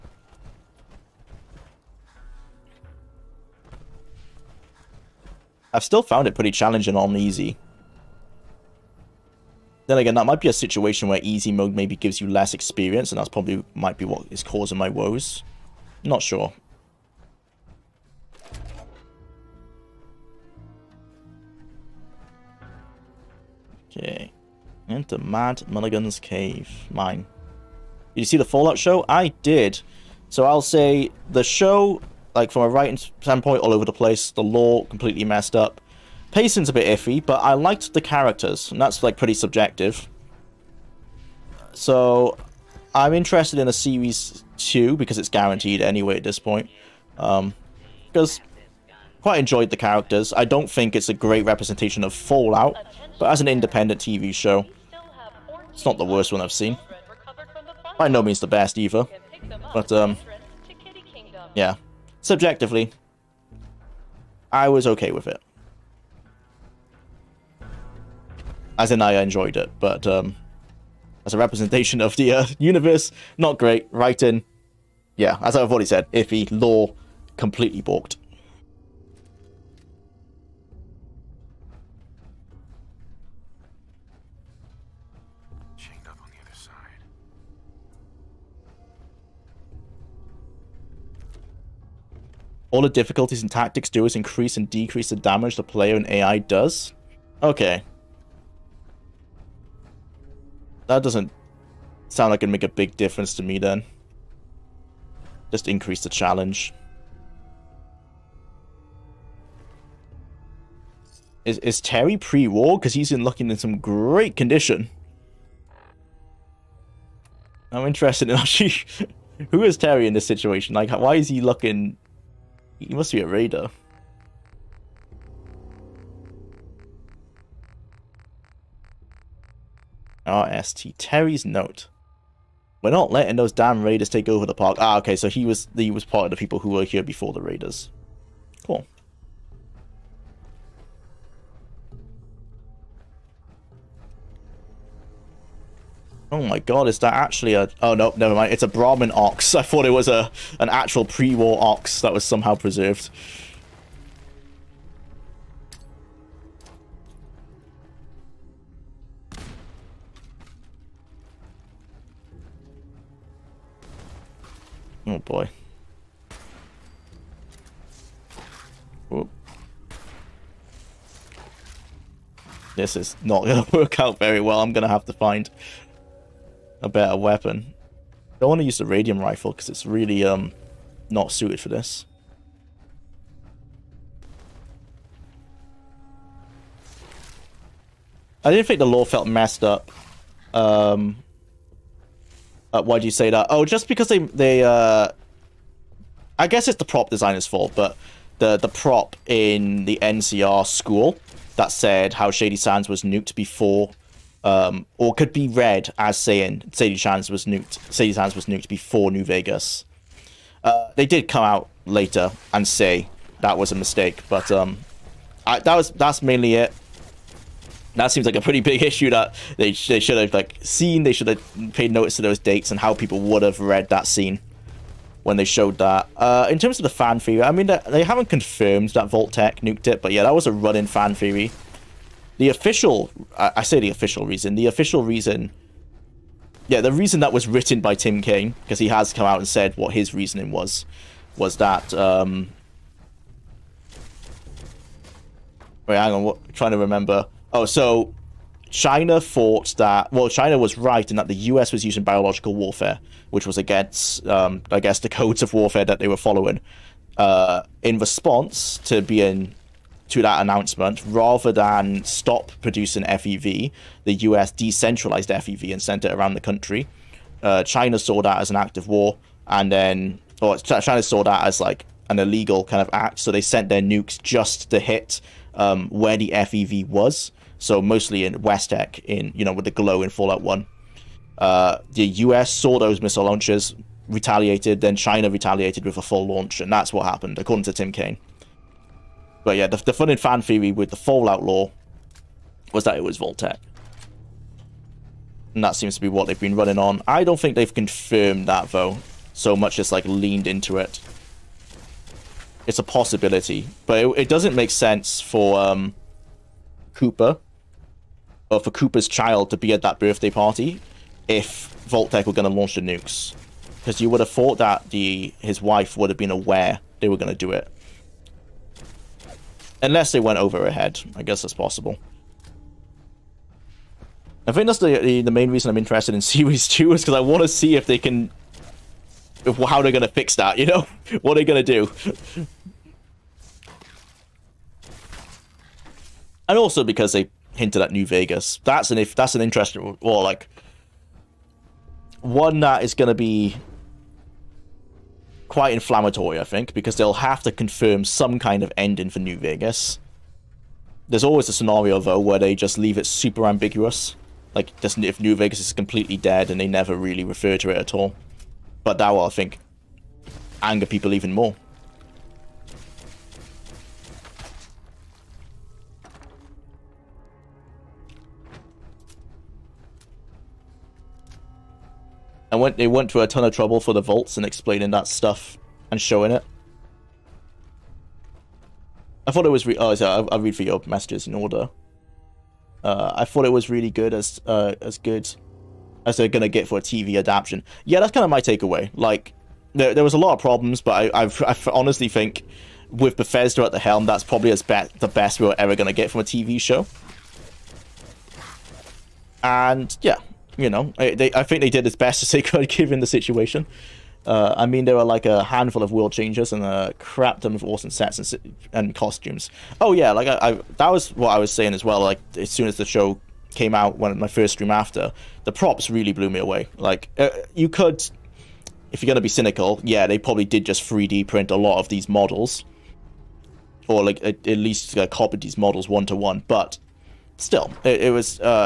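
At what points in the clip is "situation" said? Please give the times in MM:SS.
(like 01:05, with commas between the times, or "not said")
00:10, 02:00, 06:43.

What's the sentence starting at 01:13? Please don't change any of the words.
Writing, yeah, as I've already said, iffy, lore, completely balked.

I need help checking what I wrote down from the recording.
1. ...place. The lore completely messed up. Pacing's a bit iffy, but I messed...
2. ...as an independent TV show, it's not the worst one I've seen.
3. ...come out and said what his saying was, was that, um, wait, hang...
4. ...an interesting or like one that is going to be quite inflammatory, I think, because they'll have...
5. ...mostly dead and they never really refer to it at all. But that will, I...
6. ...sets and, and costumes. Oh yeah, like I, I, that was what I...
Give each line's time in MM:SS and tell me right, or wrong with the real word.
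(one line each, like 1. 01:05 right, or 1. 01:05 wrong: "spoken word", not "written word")
1. 00:33 wrong: "liked", not "messed"
2. 00:53 right
3. 03:59 wrong: "reasoning", not "saying"
4. 05:39 right
5. 05:55 wrong: "completely", not "mostly"
6. 06:47 right.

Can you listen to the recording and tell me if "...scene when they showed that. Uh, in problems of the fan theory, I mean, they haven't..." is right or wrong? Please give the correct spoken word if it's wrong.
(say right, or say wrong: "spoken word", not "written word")
wrong: "terms", not "problems".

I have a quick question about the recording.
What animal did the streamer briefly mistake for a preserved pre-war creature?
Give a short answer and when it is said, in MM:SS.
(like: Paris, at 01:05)
Brahmin ox, at 02:28.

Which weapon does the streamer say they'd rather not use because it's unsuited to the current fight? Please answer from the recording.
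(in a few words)
radium rifle.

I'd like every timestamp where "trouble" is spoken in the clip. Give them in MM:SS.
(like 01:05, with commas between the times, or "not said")
06:13.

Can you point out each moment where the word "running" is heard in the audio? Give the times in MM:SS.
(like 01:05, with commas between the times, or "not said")
03:50, 04:56.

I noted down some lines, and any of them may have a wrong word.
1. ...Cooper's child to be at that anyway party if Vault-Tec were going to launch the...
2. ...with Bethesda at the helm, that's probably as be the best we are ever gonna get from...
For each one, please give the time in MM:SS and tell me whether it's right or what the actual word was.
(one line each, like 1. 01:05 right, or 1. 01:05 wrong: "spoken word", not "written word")
1. 05:08 wrong: "birthday", not "anyway"
2. 06:32 right.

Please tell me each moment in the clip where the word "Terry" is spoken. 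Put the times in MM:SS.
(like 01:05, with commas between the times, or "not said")
01:51, 01:59, 02:10.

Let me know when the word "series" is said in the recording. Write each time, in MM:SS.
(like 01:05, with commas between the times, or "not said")
00:43, 05:26.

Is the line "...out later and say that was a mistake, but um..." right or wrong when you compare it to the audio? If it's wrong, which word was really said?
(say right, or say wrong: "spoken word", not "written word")
right.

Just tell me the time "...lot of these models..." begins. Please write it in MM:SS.
07:01.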